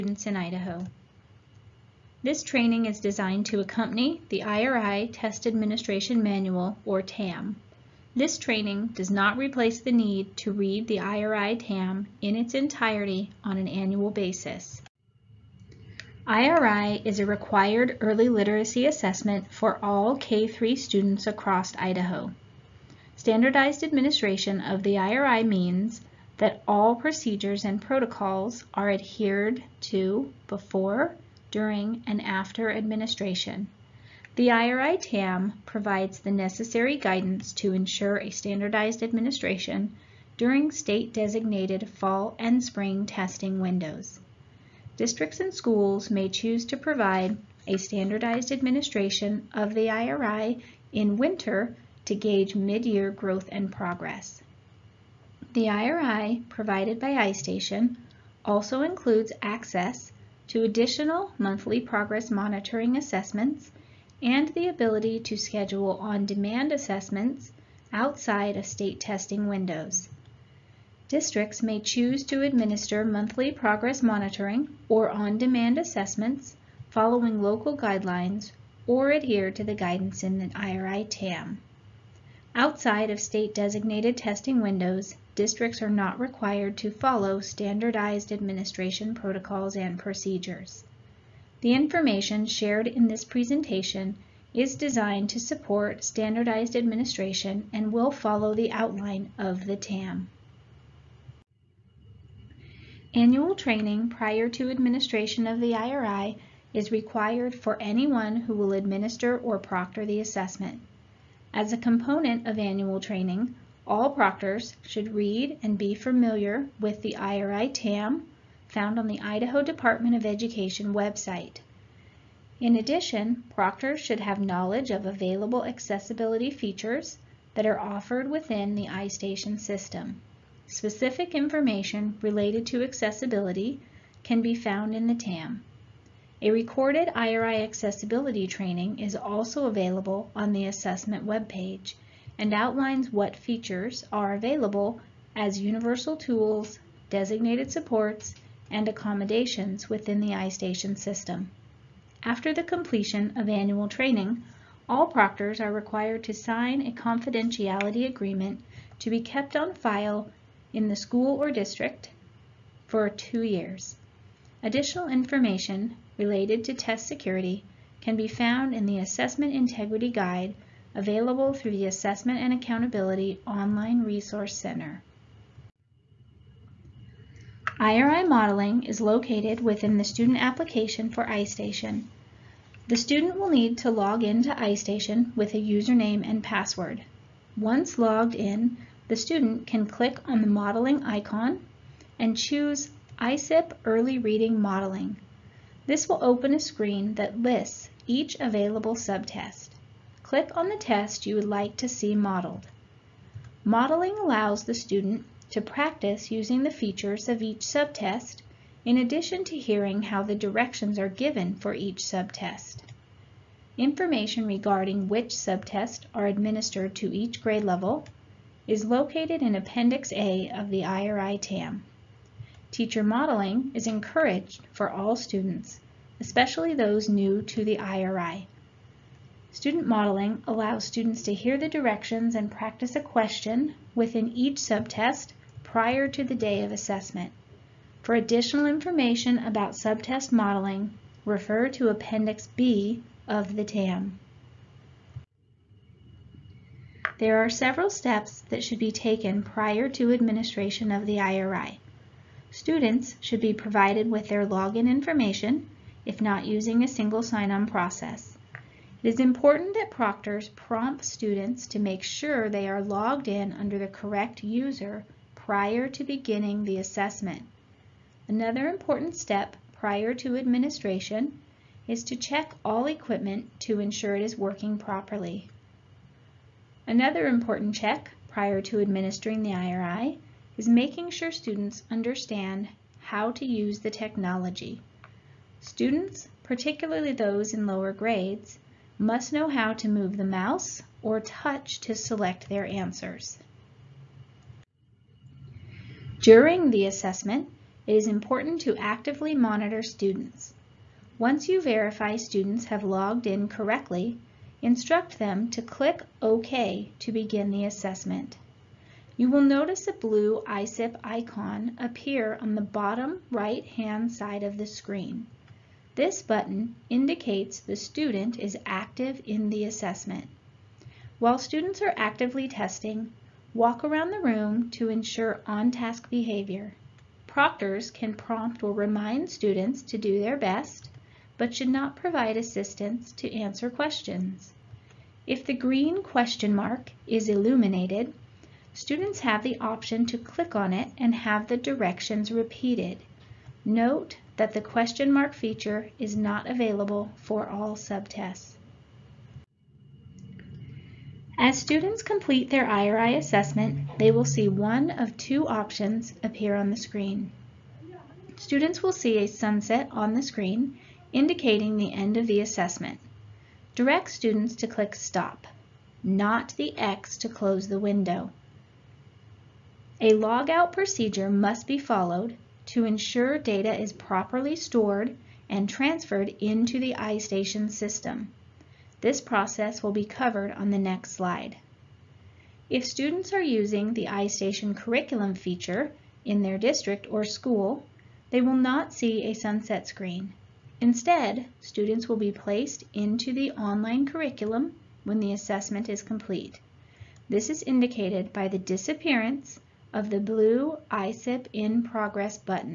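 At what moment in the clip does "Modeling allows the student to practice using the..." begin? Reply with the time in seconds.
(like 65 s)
203 s.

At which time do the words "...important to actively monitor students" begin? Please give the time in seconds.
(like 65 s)
298 s.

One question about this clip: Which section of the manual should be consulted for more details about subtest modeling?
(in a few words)
Appendix B.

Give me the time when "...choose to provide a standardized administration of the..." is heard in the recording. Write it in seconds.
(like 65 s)
46 s.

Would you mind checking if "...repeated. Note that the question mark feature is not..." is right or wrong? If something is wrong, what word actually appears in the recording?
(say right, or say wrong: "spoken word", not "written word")
right.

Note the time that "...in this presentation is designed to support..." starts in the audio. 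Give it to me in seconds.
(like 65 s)
92 s.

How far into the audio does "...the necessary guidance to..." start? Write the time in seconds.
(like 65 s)
36 s.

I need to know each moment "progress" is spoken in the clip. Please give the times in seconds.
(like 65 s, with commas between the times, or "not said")
53 s, 61 s, 73 s, 401 s.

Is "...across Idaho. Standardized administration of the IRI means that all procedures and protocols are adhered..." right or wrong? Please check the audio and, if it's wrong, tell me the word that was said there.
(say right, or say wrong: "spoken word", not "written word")
right.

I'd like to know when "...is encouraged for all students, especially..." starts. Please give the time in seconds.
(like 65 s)
223 s.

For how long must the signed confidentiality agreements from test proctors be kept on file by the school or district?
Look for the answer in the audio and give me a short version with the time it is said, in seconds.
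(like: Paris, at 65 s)
2 years, at 163 s.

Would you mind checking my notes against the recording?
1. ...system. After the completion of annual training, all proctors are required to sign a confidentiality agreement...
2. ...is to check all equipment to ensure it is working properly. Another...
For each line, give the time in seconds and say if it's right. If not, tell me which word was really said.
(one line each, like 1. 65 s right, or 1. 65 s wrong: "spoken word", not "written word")
1. 150 s right
2. 271 s right.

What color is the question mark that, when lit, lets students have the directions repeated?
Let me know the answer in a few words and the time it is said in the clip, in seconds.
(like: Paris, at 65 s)
Green, at 335 s.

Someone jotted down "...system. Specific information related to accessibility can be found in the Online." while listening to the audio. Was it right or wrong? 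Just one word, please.
wrong.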